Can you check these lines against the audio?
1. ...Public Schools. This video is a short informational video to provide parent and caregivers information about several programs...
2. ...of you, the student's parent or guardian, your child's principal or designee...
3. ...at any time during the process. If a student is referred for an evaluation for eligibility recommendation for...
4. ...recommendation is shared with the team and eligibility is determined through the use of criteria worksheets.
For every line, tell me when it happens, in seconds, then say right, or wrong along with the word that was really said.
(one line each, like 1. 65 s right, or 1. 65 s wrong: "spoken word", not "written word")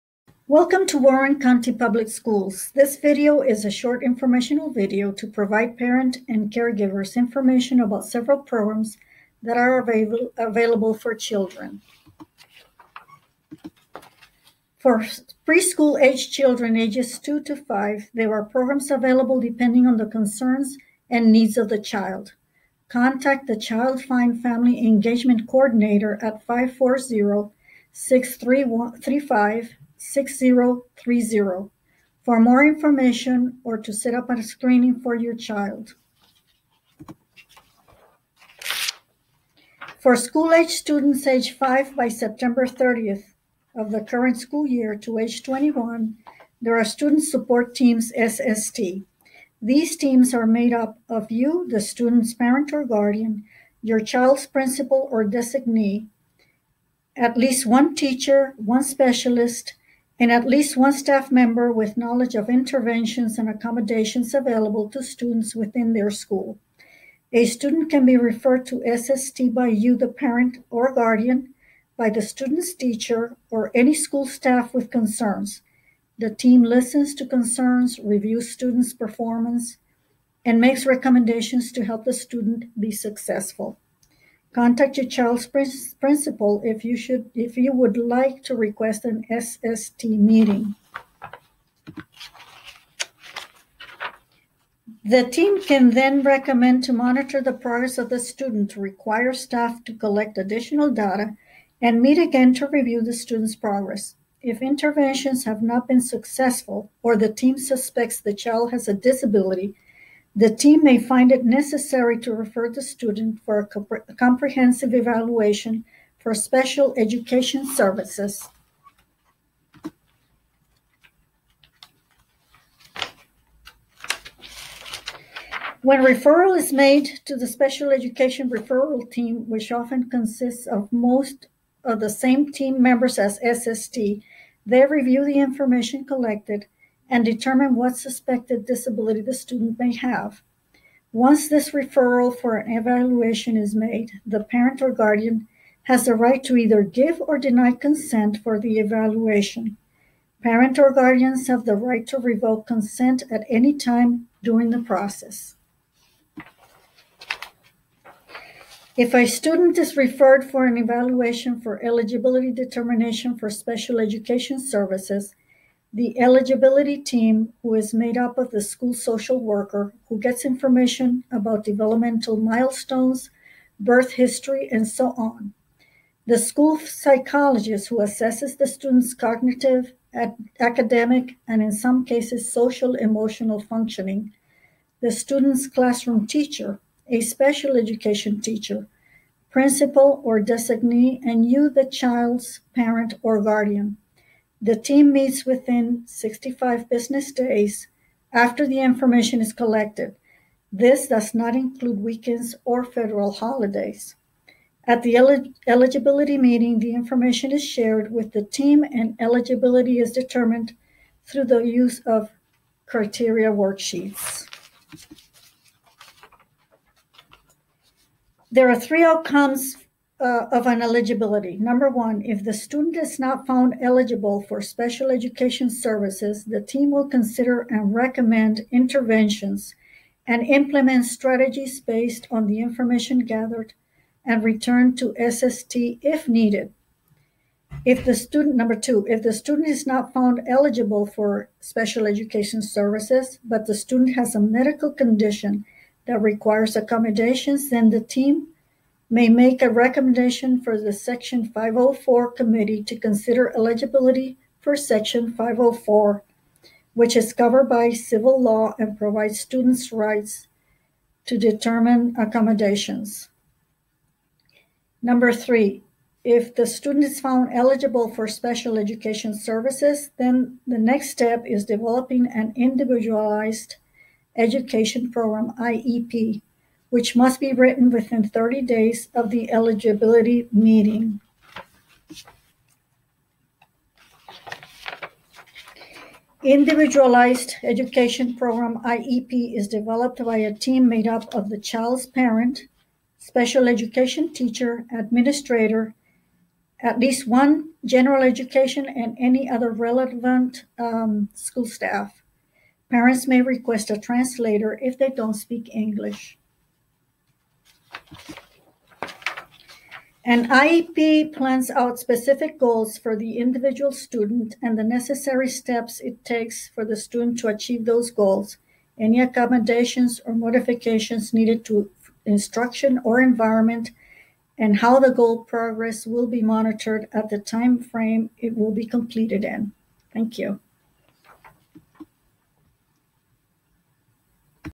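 1. 1 s right
2. 51 s right
3. 153 s wrong: "determination", not "recommendation"
4. 206 s wrong: "information", not "recommendation".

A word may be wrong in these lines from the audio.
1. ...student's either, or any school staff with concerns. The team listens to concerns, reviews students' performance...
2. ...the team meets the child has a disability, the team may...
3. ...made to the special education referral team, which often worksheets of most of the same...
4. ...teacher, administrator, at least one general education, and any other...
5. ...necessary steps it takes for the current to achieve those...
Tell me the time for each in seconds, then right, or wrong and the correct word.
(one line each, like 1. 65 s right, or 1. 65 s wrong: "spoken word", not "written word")
1. 72 s wrong: "teacher", not "either"
2. 107 s wrong: "suspects", not "meets"
3. 126 s wrong: "consists", not "worksheets"
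4. 294 s right
5. 314 s wrong: "student", not "current".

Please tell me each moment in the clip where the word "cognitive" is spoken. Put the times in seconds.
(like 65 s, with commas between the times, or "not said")
179 s.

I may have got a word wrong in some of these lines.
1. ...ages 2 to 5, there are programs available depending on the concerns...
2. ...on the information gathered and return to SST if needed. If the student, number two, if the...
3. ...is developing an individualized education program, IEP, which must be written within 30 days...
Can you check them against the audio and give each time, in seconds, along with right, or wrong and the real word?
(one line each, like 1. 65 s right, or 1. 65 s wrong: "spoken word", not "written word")
1. 16 s right
2. 232 s right
3. 271 s right.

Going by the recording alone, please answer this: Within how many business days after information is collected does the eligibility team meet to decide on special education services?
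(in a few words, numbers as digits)
65.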